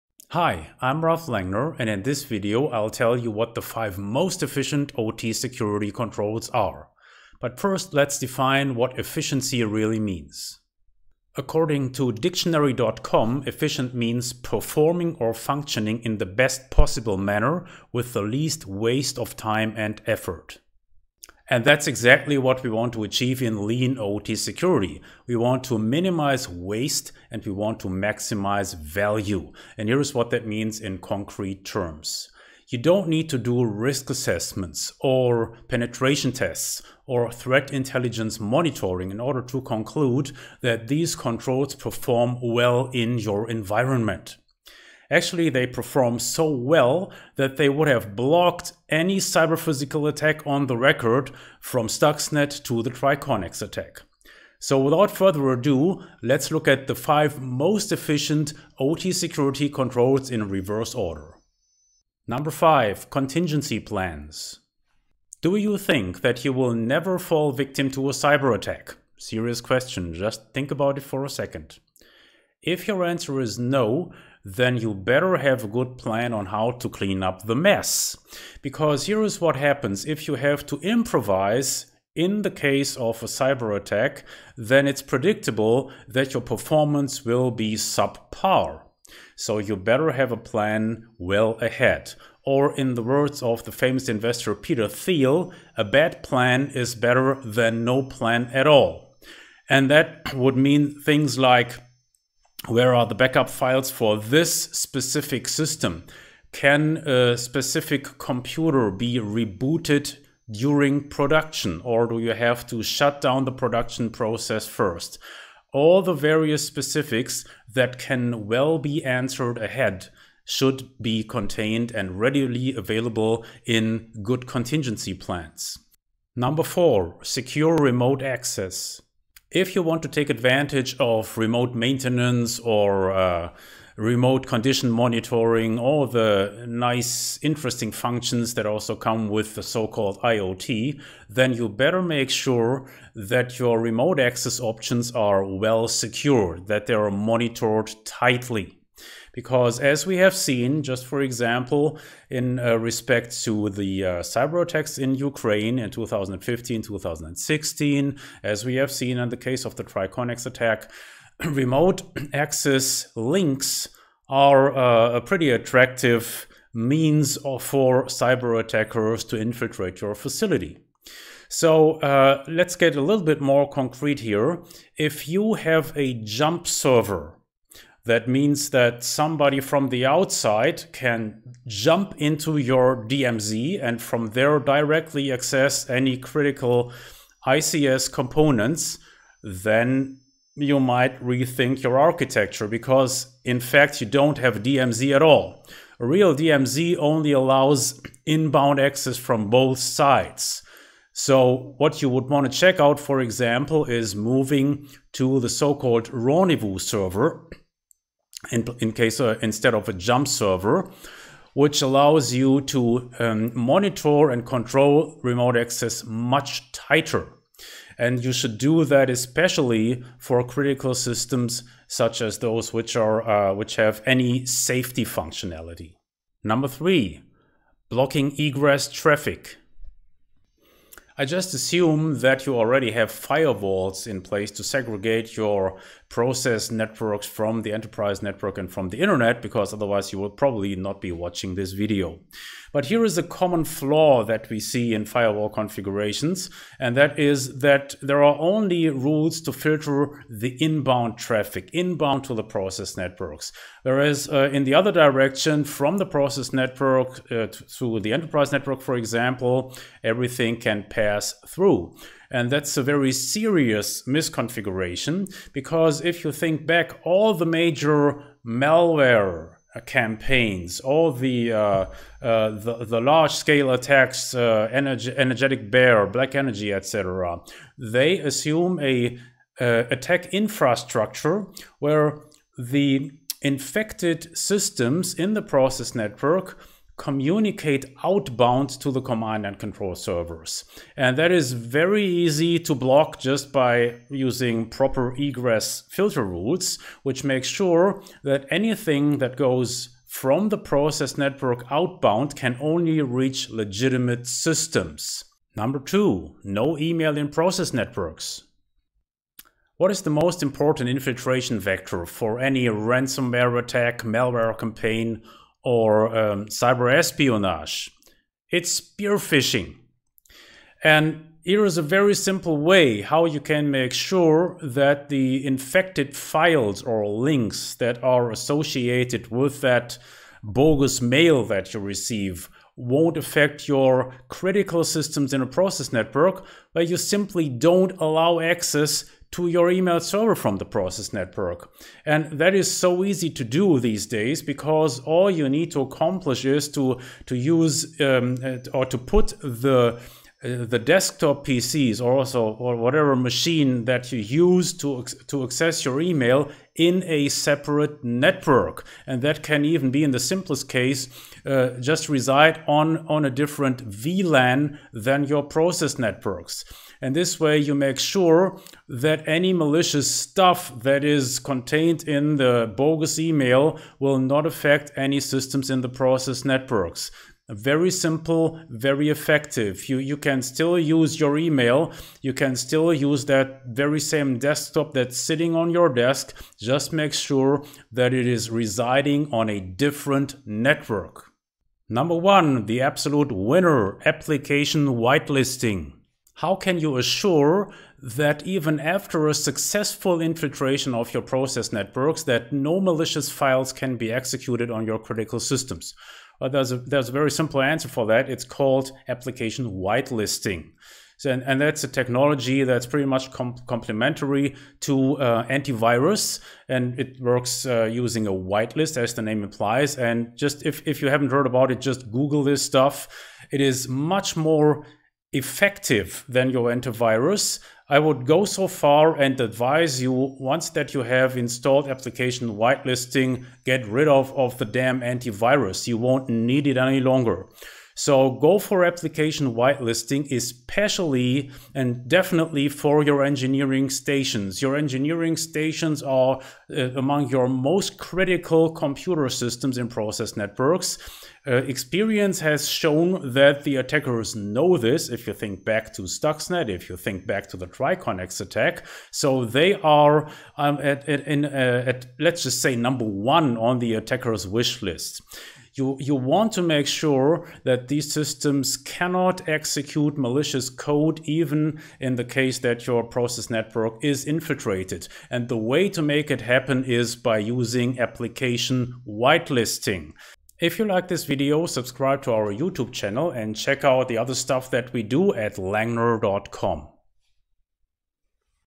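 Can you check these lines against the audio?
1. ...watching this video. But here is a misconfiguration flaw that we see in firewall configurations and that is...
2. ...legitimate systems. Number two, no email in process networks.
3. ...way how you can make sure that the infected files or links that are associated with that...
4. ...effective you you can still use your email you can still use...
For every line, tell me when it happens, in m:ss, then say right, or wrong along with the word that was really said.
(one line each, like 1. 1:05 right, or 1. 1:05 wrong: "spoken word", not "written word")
1. 4:01 wrong: "common", not "misconfiguration"
2. 5:03 right
3. 5:22 right
4. 6:19 right.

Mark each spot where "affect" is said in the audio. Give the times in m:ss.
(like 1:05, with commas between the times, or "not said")
5:33, 6:14.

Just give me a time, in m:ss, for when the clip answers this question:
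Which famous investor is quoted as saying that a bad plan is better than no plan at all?
1:34.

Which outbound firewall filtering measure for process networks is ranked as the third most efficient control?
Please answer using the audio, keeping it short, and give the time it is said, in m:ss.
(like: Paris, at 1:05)
blocking egress traffic, at 3:47.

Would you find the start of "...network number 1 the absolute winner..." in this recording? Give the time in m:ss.
6:30.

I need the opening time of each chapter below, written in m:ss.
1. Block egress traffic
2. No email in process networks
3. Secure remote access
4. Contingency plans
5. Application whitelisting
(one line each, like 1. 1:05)
1. 3:46
2. 5:05
3. 2:05
4. 1:01
5. 6:31.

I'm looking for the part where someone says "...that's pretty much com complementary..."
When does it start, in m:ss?
6:52.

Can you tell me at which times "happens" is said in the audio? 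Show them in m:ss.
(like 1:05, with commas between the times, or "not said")
1:19, 7:56.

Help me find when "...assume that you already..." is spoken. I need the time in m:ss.
3:51.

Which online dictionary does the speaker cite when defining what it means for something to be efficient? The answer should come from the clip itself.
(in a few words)
dictionary.com.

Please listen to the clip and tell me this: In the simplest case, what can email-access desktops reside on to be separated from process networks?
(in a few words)
a different VLAN.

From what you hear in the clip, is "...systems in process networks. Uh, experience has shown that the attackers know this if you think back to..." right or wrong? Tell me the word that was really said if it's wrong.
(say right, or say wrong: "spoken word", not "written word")
right.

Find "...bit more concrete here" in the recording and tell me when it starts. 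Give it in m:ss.
2:53.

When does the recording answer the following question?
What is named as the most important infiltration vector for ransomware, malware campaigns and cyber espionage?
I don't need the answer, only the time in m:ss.
5:18.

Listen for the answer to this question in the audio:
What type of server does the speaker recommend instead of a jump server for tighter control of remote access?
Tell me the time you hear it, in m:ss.
3:26.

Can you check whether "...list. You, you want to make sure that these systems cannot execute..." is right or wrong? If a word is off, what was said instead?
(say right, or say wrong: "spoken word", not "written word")
right.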